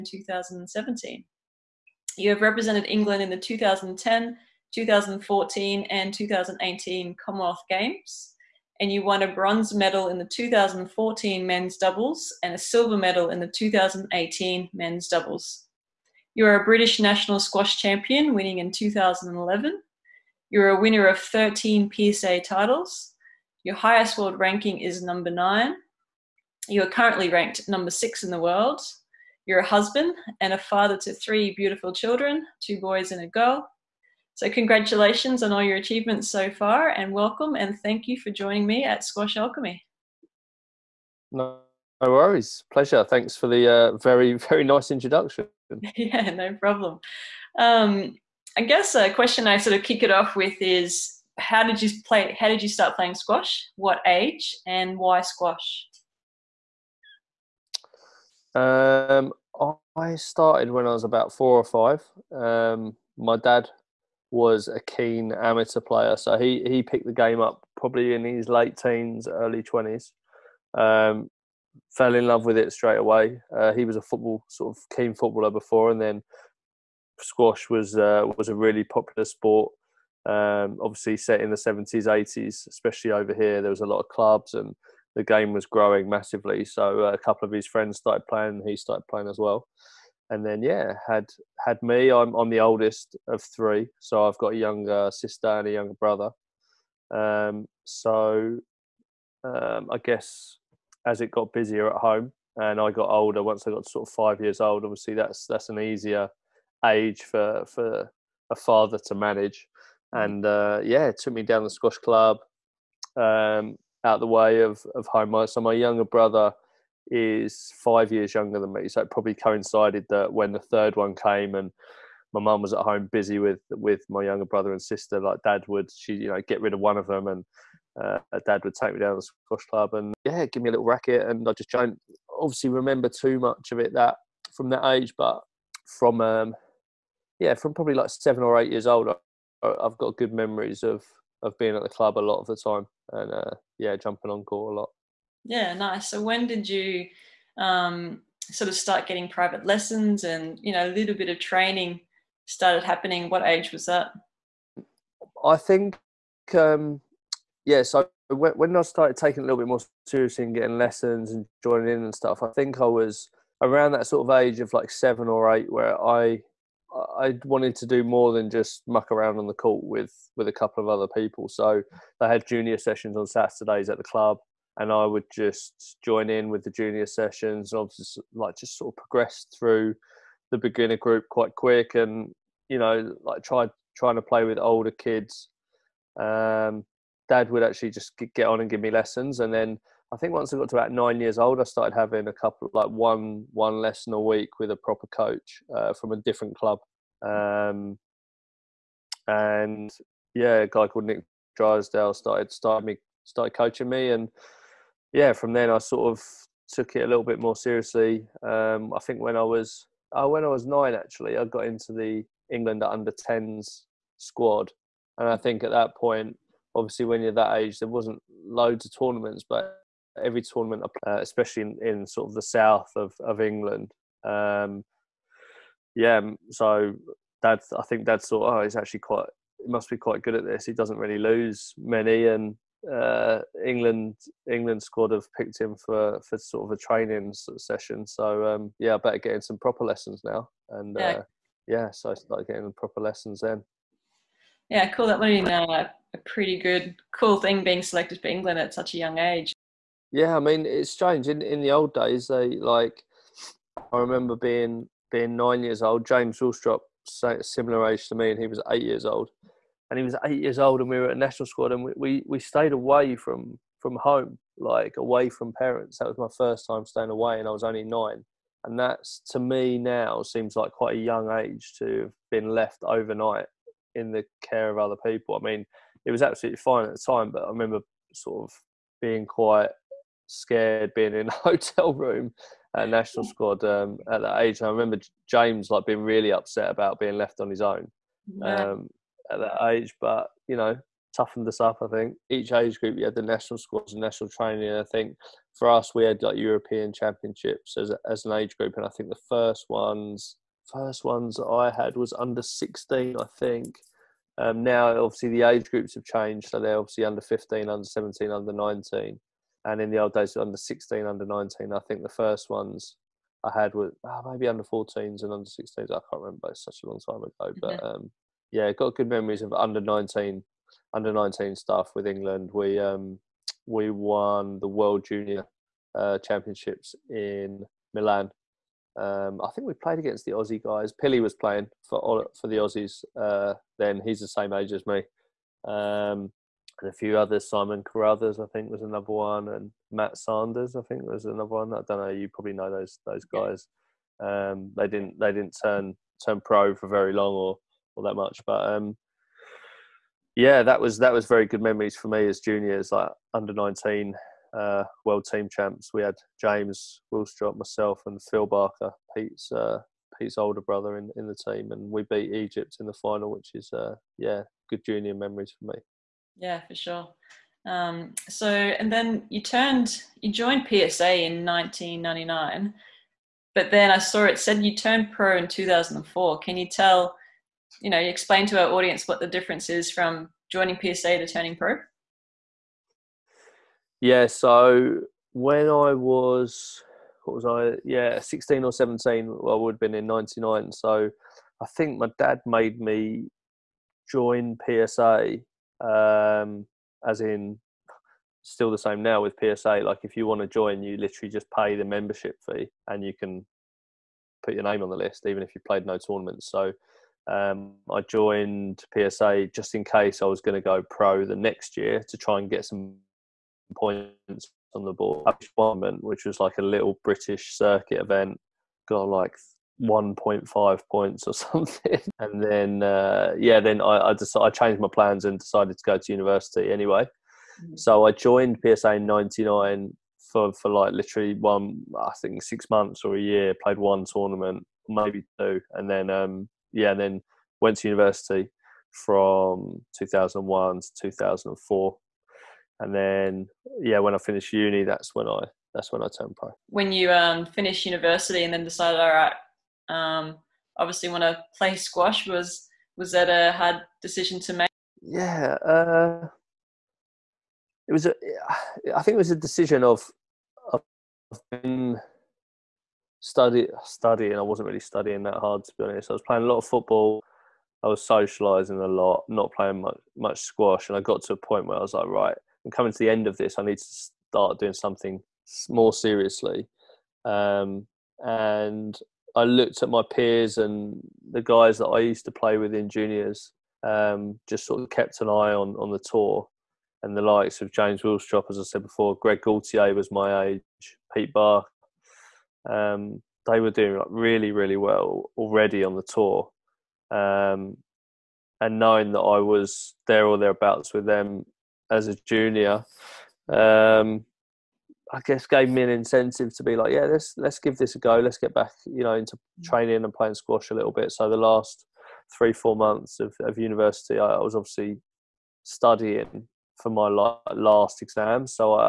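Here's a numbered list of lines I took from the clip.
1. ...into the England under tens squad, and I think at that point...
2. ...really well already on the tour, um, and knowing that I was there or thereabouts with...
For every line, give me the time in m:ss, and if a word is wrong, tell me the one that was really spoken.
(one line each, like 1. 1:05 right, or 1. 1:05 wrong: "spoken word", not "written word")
1. 3:31 right
2. 8:14 right.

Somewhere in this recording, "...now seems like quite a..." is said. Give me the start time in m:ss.
4:29.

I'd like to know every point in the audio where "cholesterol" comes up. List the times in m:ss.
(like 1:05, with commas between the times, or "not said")
not said.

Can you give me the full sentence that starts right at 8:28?
Let's get back, you know, into mm.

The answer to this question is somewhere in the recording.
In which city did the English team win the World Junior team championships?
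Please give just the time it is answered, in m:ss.
5:27.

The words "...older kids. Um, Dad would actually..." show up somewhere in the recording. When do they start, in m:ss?
3:04.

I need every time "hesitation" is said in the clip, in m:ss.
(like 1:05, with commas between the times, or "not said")
not said.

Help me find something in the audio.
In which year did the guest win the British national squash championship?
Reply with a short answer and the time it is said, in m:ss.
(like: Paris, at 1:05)
2011, at 0:18.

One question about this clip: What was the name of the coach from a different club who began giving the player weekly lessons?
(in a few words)
Nick Drysdale.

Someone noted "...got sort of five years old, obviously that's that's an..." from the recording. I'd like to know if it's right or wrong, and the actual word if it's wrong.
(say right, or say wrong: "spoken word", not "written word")
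right.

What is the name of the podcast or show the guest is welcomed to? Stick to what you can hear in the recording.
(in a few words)
Squash Alchemy.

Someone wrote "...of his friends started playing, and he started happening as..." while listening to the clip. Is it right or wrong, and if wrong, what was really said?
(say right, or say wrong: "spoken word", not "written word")
wrong: "playing", not "happening".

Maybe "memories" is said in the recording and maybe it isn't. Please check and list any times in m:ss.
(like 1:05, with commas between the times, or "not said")
2:20, 5:19, 5:51, 6:05.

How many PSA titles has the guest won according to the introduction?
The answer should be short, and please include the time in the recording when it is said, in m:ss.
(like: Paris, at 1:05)
13, at 0:21.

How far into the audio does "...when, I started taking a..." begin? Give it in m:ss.
2:38.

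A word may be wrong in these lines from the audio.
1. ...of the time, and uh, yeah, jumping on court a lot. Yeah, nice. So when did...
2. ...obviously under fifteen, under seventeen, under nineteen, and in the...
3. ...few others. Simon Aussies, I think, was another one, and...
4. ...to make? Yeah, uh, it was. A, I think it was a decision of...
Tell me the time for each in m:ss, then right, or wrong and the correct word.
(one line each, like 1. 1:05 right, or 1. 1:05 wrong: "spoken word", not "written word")
1. 2:22 right
2. 5:06 right
3. 5:36 wrong: "Carruthers", not "Aussies"
4. 7:34 right.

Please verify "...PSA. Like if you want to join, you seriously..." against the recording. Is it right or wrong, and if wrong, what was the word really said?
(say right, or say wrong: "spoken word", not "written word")
wrong: "literally", not "seriously".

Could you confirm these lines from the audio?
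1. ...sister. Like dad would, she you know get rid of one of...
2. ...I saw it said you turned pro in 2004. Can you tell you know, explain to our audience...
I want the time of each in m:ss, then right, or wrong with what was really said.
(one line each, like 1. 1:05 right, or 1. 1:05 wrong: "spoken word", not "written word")
1. 2:04 right
2. 6:13 right.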